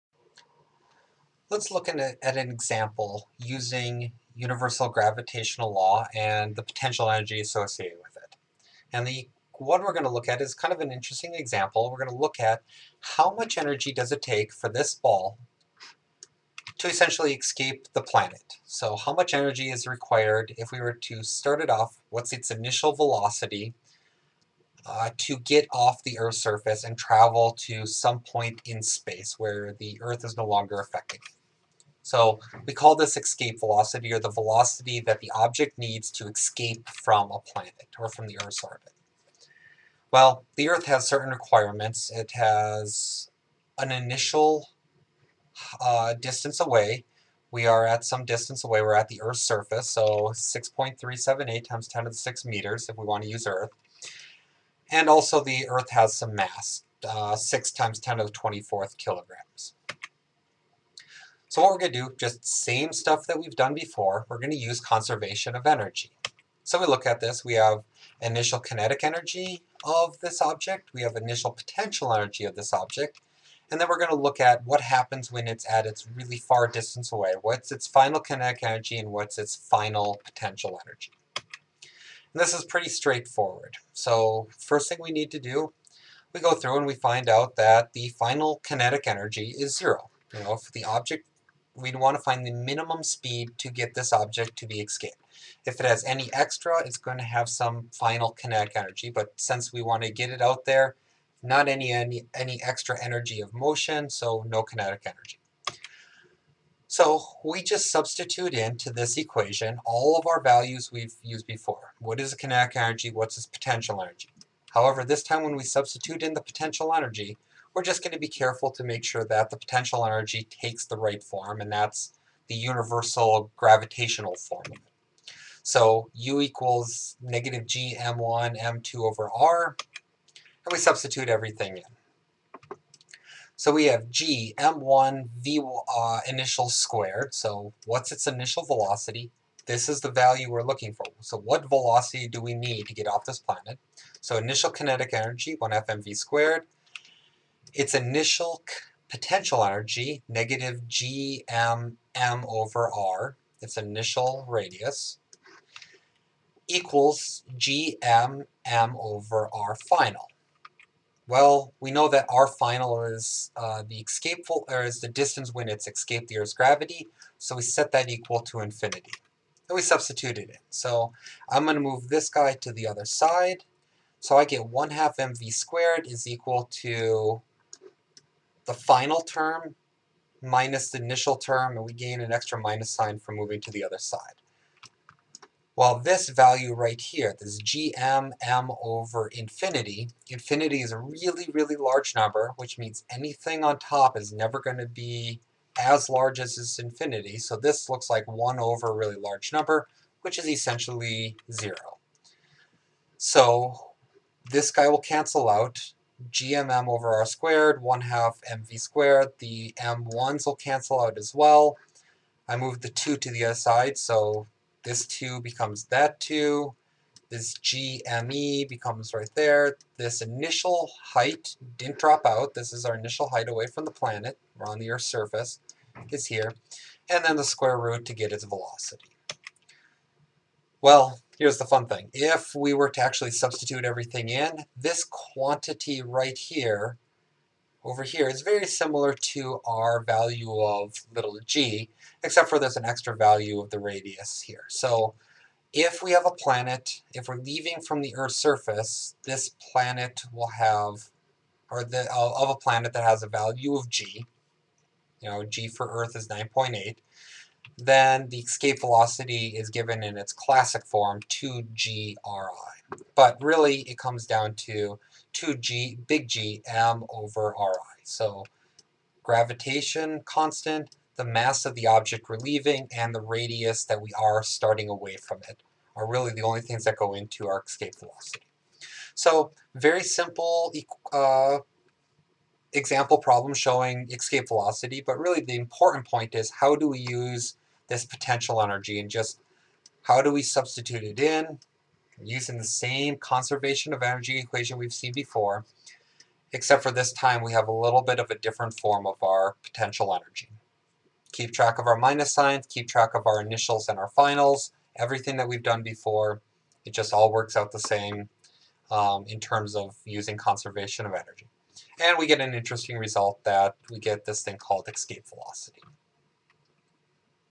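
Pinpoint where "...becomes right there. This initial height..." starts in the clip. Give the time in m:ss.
3:38.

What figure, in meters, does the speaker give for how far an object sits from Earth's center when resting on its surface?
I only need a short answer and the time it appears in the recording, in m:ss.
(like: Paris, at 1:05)
6.378 x 10^6 meters, at 0:50.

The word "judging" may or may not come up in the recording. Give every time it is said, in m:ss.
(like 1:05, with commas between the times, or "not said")
not said.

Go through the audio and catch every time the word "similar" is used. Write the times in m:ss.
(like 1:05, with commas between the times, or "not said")
3:58.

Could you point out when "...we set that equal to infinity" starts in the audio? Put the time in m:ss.
2:47.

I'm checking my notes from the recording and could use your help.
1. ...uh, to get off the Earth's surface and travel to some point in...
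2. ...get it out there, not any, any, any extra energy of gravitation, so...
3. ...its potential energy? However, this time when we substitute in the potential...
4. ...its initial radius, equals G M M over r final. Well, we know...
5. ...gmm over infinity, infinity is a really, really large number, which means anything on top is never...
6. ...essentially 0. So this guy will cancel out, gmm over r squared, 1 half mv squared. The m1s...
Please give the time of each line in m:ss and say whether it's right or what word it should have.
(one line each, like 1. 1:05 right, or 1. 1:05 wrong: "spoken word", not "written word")
1. 0:24 right
2. 1:40 wrong: "motion", not "gravitation"
3. 1:53 right
4. 2:33 right
5. 3:07 right
6. 3:20 right.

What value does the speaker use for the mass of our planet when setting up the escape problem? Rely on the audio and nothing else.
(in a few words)
6 x 10^24 kilograms.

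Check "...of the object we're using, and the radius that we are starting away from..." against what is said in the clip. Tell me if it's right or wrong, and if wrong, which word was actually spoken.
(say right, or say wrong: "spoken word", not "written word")
wrong: "leaving", not "using".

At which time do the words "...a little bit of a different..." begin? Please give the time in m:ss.
4:57.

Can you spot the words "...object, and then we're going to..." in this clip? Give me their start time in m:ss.
1:12.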